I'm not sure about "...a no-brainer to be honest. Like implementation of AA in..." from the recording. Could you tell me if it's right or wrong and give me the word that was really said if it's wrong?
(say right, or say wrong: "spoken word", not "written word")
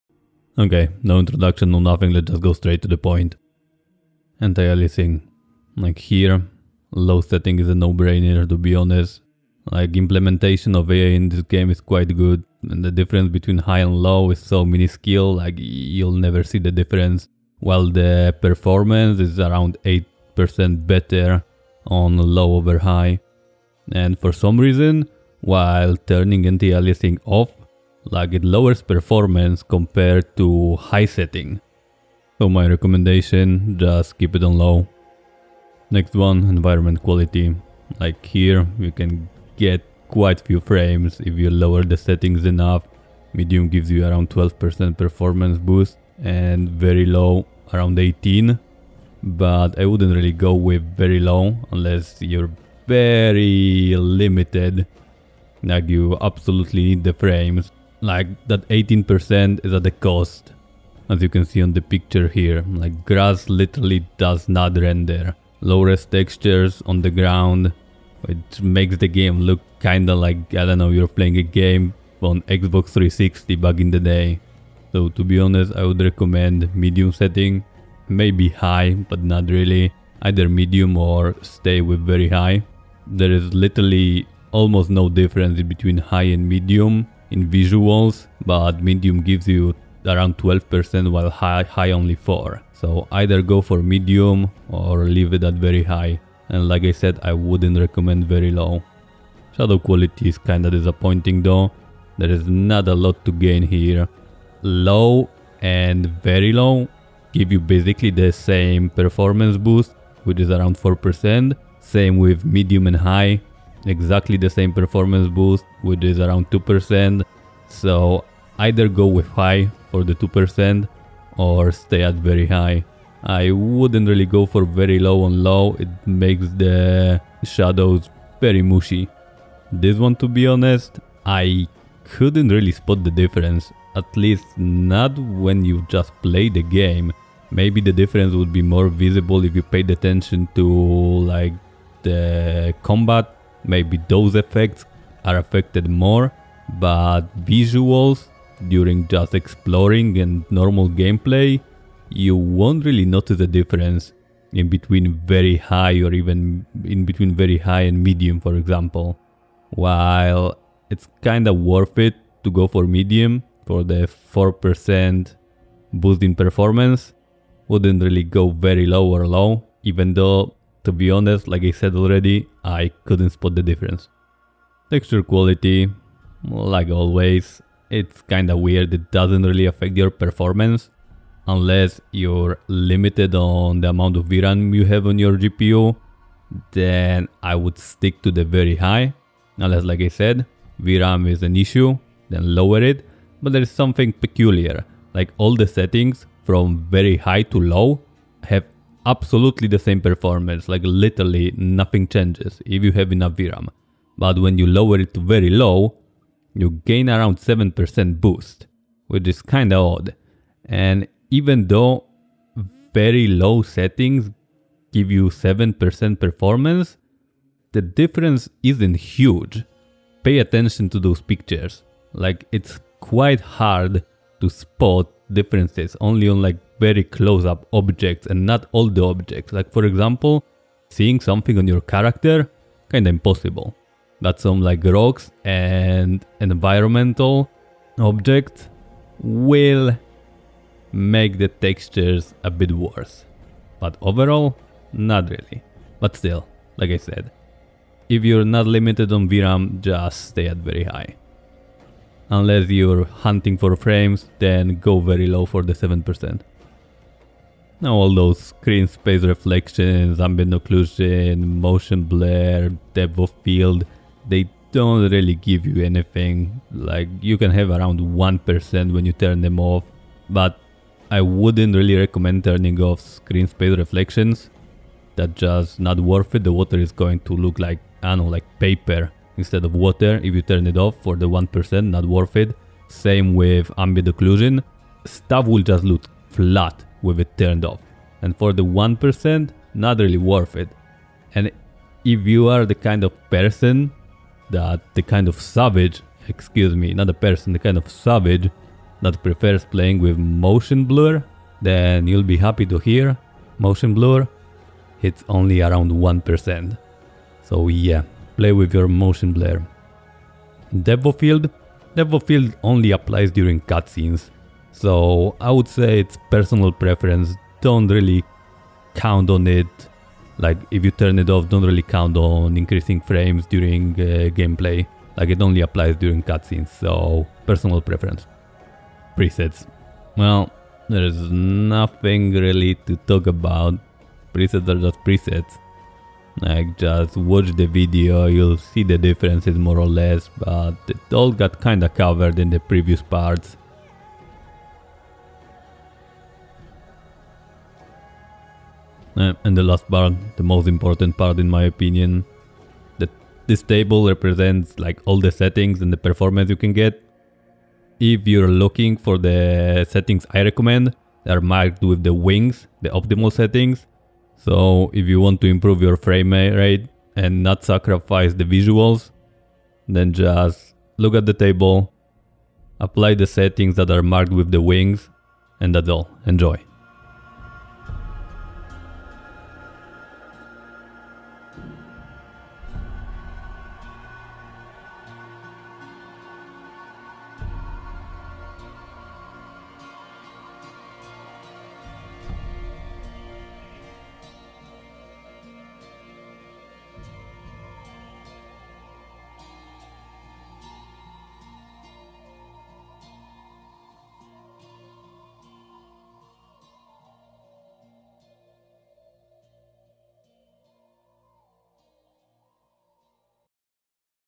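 right.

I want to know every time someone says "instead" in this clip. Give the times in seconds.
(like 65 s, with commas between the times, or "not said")
279 s.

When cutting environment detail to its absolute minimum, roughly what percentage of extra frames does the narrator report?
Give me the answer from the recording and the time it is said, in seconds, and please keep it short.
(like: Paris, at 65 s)
18%, at 46 s.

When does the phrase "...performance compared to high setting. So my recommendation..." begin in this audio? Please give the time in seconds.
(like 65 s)
28 s.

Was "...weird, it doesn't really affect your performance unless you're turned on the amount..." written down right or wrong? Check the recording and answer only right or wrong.
wrong.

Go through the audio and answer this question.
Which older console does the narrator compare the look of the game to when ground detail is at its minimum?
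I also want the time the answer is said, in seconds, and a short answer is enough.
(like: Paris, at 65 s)
Xbox 360, at 72 s.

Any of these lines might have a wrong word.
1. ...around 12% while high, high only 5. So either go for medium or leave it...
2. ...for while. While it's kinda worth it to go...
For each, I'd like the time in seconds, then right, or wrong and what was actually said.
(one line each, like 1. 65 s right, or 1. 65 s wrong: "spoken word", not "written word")
1. 90 s wrong: "4", not "5"
2. 158 s wrong: "example", not "while".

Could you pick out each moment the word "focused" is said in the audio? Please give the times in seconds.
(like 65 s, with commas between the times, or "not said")
not said.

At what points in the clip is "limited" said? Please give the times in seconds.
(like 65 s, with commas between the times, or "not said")
53 s, 182 s, 248 s.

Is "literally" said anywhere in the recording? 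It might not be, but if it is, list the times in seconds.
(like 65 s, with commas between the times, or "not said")
63 s, 83 s, 200 s.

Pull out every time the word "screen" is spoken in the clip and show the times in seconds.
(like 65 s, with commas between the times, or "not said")
258 s, 273 s.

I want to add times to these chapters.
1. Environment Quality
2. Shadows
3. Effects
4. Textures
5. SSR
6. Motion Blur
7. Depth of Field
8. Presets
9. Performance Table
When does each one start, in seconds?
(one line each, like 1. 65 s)
1. 35 s
2. 99 s
3. 130 s
4. 175 s
5. 257 s
6. 296 s
7. 310 s
8. 329 s
9. 349 s.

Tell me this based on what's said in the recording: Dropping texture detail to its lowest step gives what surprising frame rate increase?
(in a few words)
7%.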